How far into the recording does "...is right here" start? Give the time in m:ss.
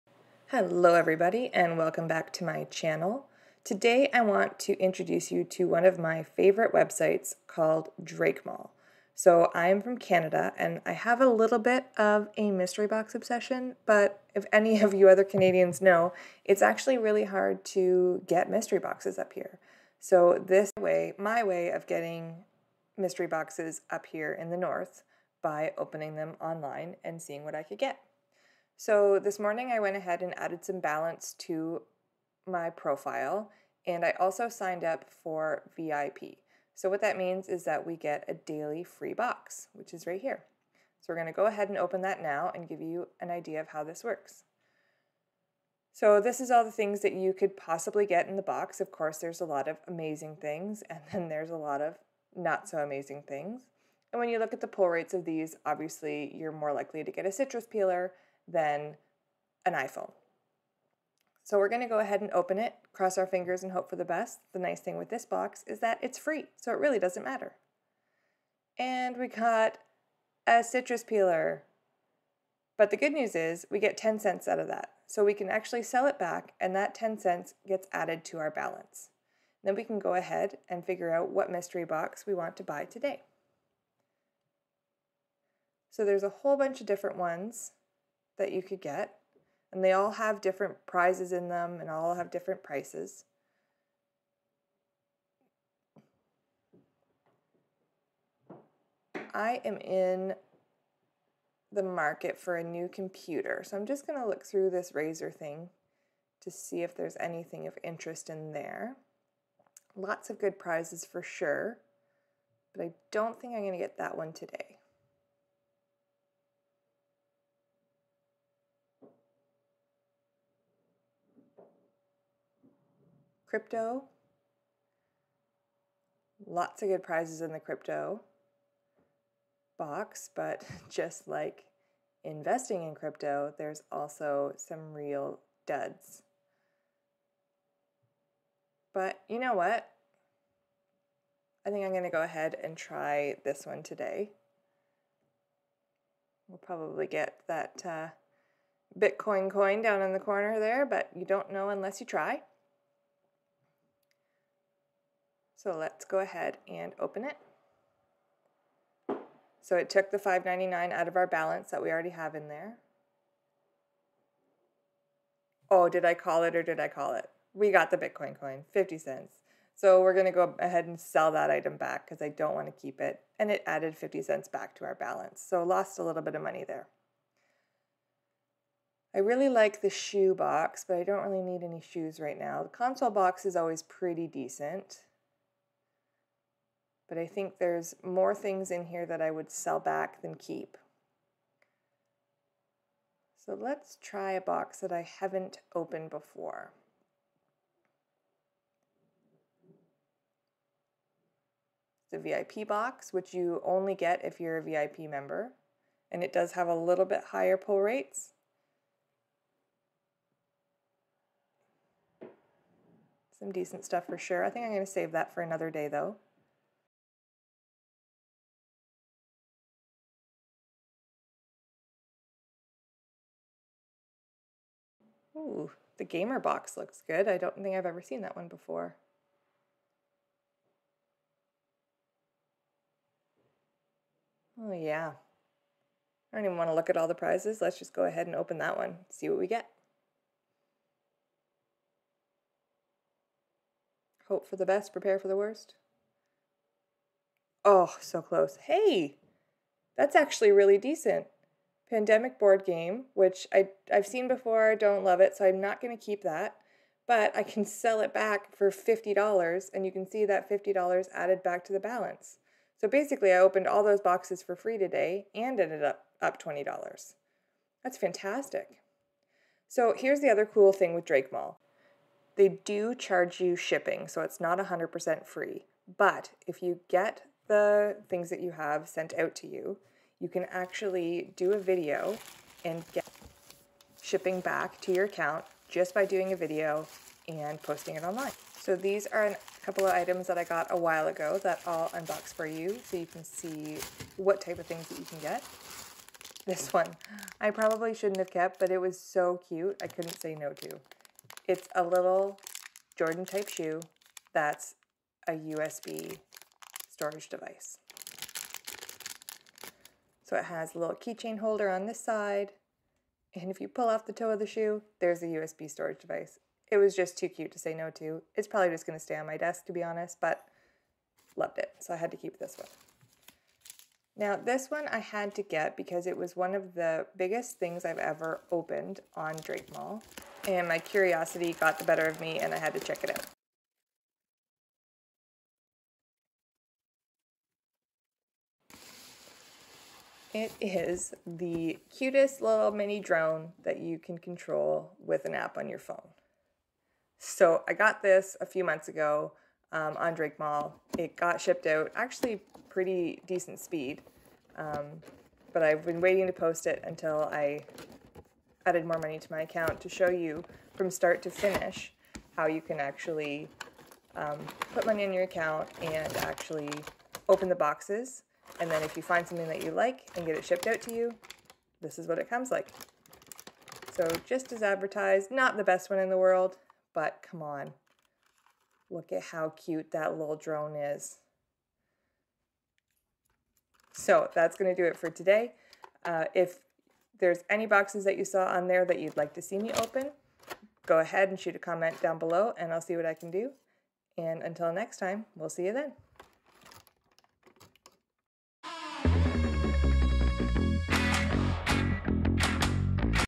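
0:39.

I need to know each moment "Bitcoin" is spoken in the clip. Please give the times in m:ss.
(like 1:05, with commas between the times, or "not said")
2:28, 2:47.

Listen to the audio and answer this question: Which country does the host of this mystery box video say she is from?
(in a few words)
Canada.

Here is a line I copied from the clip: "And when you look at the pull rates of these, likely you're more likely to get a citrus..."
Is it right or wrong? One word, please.
wrong.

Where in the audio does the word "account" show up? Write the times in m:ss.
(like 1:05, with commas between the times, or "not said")
4:45, 5:59, 6:05.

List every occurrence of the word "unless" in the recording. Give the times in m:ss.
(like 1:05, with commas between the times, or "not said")
2:31.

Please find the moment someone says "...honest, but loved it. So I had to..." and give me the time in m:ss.
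5:19.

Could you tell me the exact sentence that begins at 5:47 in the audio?
So I got this a few months ago um, on Drakemall.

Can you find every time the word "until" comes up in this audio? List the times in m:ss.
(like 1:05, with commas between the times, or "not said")
5:56, 6:34.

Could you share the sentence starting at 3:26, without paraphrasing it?
And it does have a little bit higher pull rates.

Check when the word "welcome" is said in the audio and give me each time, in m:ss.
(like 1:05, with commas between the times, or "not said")
0:01.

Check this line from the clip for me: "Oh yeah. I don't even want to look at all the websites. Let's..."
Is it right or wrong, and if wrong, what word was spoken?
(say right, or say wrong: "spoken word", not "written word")
wrong: "prizes", not "websites".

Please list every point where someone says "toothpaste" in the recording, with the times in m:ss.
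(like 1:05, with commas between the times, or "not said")
not said.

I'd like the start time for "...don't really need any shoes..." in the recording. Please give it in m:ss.
3:01.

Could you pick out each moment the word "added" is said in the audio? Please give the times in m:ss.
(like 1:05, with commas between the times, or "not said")
0:30, 1:17, 2:53, 4:21, 5:58.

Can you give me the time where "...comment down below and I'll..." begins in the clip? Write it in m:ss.
6:31.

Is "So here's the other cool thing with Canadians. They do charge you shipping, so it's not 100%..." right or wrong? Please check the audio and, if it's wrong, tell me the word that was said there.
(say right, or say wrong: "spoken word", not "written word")
wrong: "Drakemall", not "Canadians".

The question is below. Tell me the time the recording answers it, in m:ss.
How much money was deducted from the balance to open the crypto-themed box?
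2:40.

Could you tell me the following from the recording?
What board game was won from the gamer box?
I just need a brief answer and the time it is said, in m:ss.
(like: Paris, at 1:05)
Pandemic, at 4:11.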